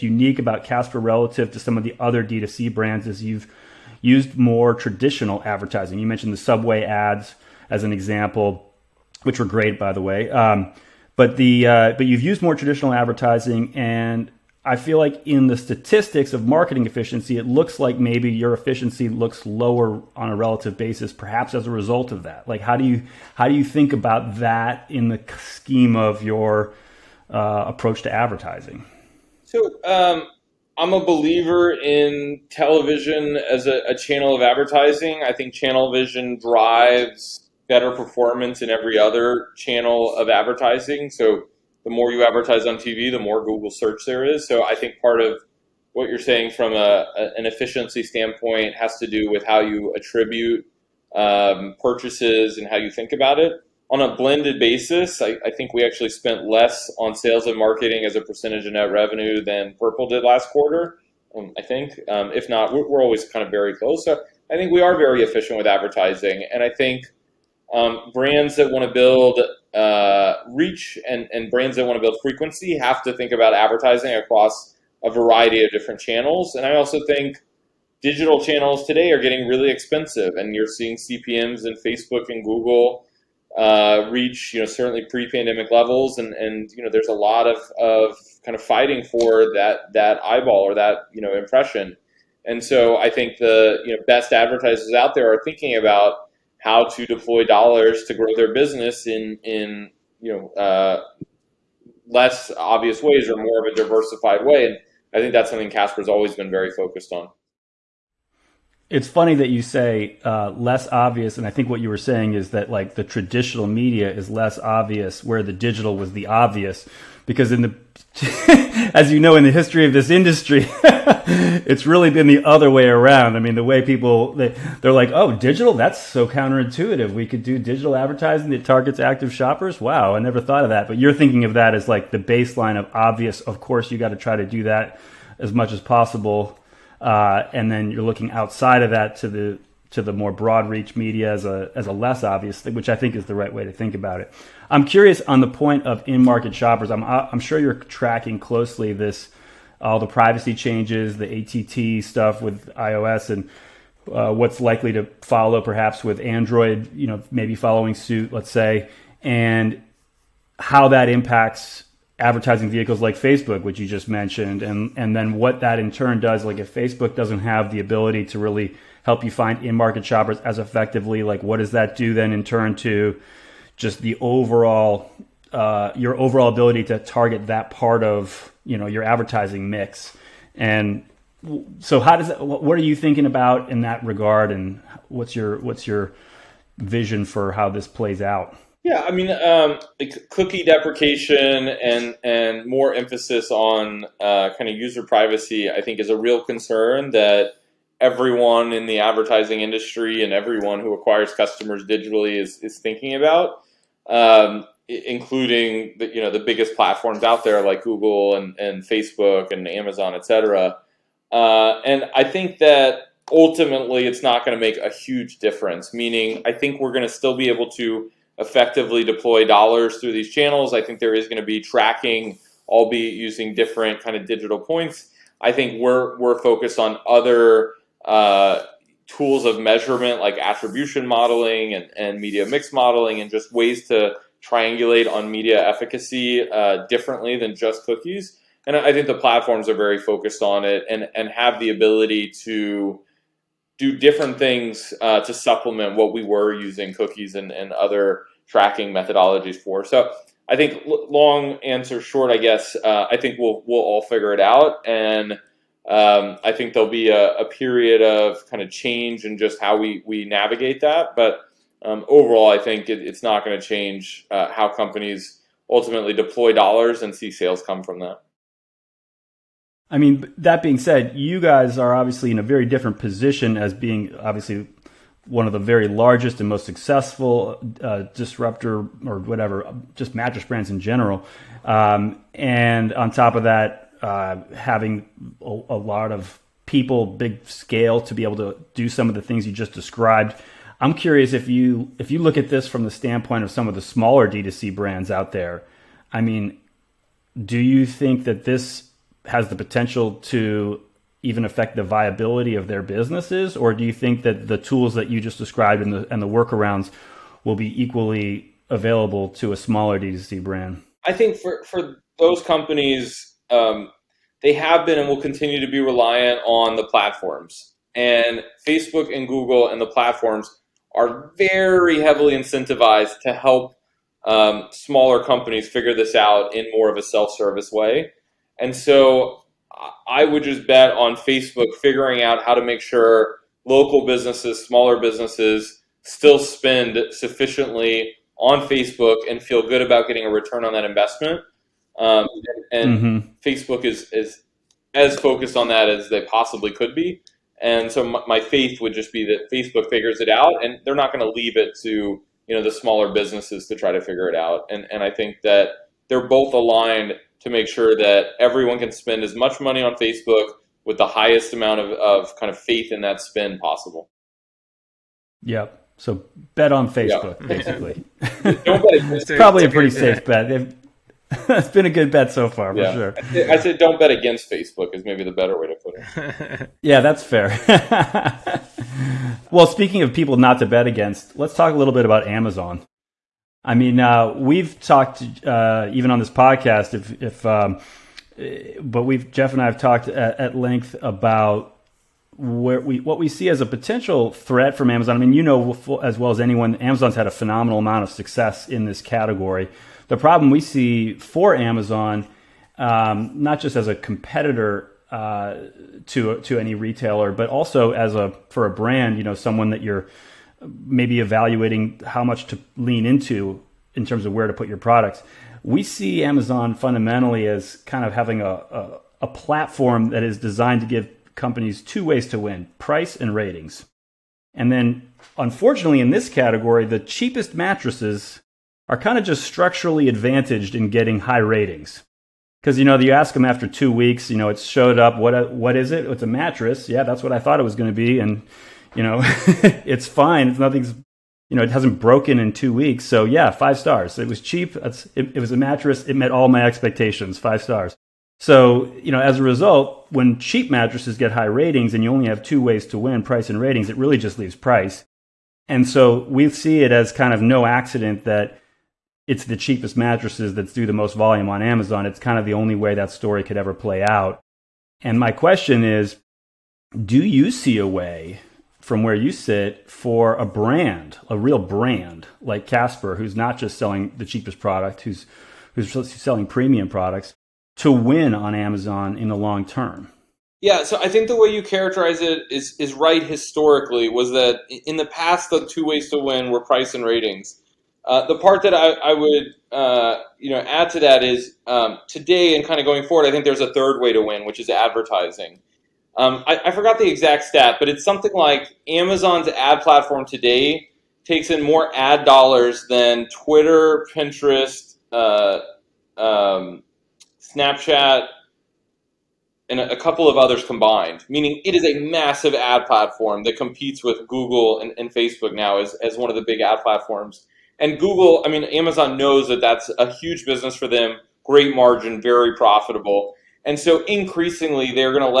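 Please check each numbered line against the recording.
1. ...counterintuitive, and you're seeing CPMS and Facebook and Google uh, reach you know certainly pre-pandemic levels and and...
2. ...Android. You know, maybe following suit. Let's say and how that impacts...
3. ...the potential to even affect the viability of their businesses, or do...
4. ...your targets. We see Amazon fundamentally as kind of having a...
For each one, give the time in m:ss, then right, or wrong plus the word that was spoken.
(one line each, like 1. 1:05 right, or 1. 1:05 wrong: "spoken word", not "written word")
1. 1:19 wrong: "expensive", not "counterintuitive"
2. 2:36 right
3. 4:59 right
4. 6:54 wrong: "products", not "targets".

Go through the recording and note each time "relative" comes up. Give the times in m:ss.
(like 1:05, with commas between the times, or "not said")
0:00, 0:20.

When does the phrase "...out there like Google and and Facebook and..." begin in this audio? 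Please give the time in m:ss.
3:27.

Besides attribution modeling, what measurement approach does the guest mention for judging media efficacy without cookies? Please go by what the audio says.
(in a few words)
Media mix modeling.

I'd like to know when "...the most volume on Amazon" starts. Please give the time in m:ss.
7:40.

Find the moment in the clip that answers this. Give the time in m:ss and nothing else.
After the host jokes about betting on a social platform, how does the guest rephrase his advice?
6:13.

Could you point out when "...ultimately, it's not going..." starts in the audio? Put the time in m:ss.
3:33.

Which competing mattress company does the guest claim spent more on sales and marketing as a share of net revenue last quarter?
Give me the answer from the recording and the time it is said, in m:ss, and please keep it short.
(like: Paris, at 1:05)
Purple, at 0:59.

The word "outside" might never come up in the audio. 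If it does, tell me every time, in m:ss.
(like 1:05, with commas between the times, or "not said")
2:18.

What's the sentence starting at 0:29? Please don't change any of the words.
So um, I'm a believer in television as a, a, channel of advertising.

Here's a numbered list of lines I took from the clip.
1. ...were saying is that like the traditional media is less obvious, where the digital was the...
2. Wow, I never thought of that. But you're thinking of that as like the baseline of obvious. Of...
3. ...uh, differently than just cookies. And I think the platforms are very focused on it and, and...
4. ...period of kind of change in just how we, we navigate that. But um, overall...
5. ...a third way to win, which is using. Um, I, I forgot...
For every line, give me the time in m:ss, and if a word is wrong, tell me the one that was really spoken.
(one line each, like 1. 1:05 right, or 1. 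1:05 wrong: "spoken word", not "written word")
1. 1:51 right
2. 2:09 right
3. 3:56 right
4. 4:17 right
5. 8:13 wrong: "advertising", not "using".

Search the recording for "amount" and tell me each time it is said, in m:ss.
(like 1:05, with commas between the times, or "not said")
6:01, 6:37.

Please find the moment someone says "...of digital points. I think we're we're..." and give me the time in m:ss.
3:44.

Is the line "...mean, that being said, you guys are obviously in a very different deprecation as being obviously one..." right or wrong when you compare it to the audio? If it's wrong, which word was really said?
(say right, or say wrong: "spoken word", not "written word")
wrong: "position", not "deprecation".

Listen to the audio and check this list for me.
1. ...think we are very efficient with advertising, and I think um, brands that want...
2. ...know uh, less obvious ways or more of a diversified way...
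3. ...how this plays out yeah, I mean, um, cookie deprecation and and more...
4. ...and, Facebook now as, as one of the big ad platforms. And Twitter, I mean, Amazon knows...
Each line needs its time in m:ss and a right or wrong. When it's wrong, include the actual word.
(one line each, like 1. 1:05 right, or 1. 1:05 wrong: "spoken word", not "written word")
1. 1:04 right
2. 1:40 right
3. 3:07 right
4. 8:34 wrong: "Google", not "Twitter".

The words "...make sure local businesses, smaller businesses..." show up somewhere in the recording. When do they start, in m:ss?
5:32.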